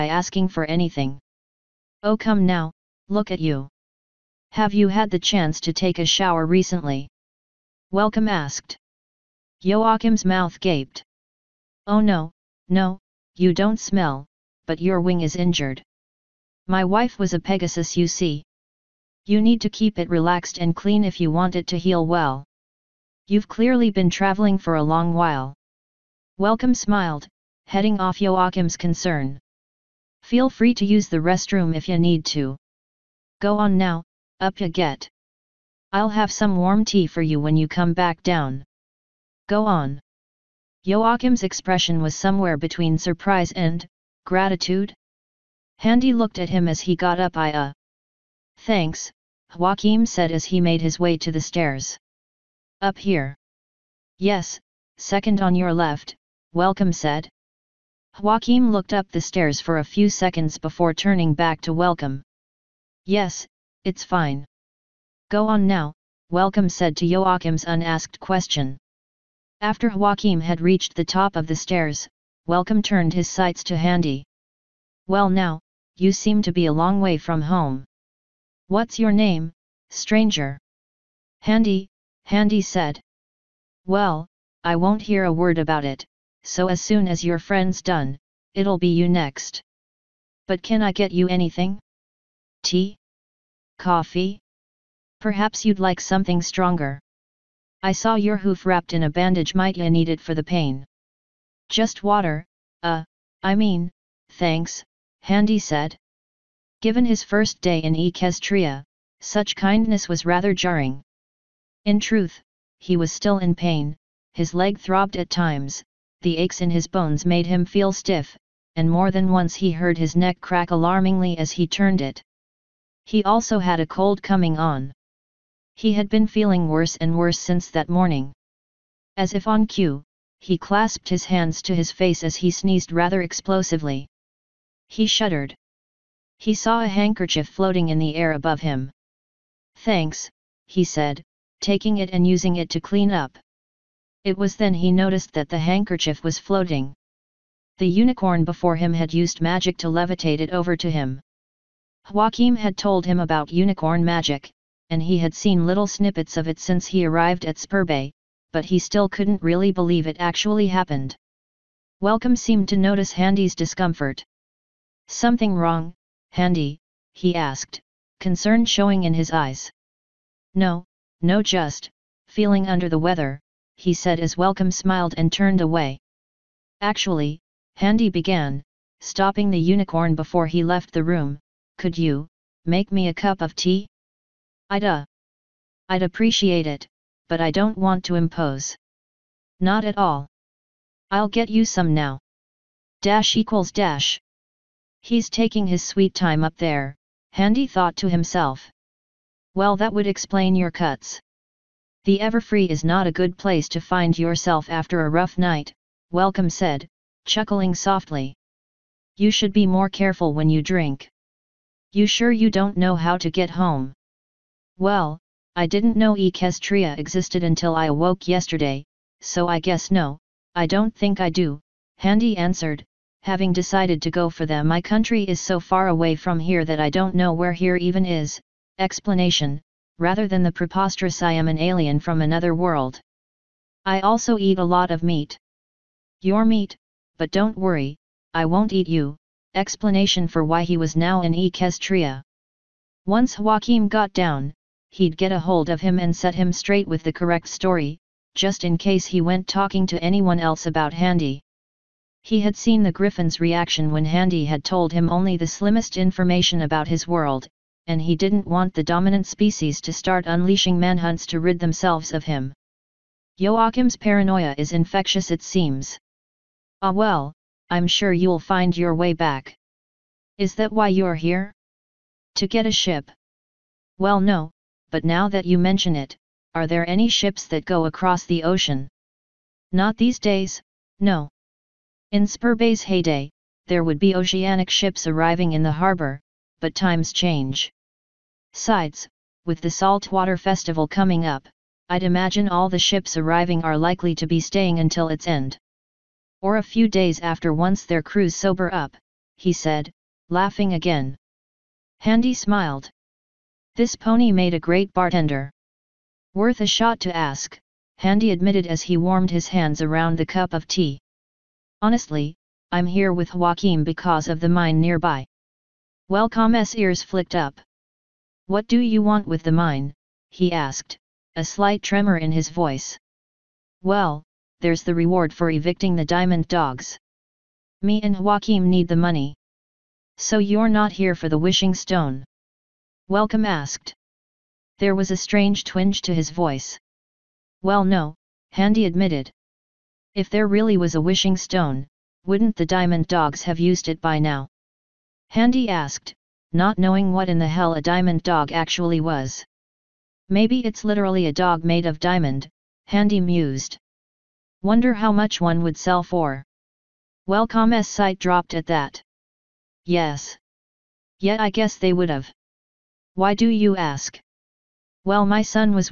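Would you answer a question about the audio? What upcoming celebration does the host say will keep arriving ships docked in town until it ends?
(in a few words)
Saltwater Festival.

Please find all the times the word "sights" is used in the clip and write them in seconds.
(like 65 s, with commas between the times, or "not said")
73 s, 357 s.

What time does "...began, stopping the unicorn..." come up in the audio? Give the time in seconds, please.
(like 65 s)
178 s.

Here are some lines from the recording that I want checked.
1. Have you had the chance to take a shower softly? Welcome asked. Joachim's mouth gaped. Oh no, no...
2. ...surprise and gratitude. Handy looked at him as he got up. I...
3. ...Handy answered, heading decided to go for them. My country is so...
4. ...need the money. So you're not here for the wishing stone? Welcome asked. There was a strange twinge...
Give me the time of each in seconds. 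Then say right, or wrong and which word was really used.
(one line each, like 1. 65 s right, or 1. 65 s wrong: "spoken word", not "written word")
1. 4 s wrong: "recently", not "softly"
2. 42 s right
3. 221 s wrong: "having", not "heading"
4. 328 s right.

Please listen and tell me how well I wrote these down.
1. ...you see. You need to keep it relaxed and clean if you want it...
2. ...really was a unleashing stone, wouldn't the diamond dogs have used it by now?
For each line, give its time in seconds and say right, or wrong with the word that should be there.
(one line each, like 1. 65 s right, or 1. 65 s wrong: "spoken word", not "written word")
1. 17 s right
2. 340 s wrong: "wishing", not "unleashing".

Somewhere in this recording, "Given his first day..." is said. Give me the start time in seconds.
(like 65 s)
106 s.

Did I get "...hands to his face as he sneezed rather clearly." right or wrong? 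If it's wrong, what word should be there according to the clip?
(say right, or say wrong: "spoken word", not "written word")
wrong: "explosively", not "clearly".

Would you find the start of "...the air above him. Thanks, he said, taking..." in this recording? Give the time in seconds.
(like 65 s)
137 s.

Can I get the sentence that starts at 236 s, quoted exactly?
Your meat, but don't worry, I won't eat you.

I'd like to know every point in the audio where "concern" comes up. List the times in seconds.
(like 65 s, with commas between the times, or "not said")
28 s, 168 s.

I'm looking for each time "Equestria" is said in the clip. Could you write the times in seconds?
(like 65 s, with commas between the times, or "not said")
107 s, 216 s, 241 s.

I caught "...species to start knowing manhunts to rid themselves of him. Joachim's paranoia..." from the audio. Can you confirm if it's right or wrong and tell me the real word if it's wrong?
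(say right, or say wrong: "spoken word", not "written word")
wrong: "unleashing", not "knowing".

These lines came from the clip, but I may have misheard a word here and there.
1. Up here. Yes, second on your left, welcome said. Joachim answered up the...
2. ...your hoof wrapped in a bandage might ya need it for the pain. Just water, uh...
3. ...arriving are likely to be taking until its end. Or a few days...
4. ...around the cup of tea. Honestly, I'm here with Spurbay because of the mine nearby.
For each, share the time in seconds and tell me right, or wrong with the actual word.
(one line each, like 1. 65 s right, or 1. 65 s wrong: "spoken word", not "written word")
1. 52 s wrong: "looked", not "answered"
2. 98 s right
3. 293 s wrong: "staying", not "taking"
4. 309 s wrong: "Joachim", not "Spurbay".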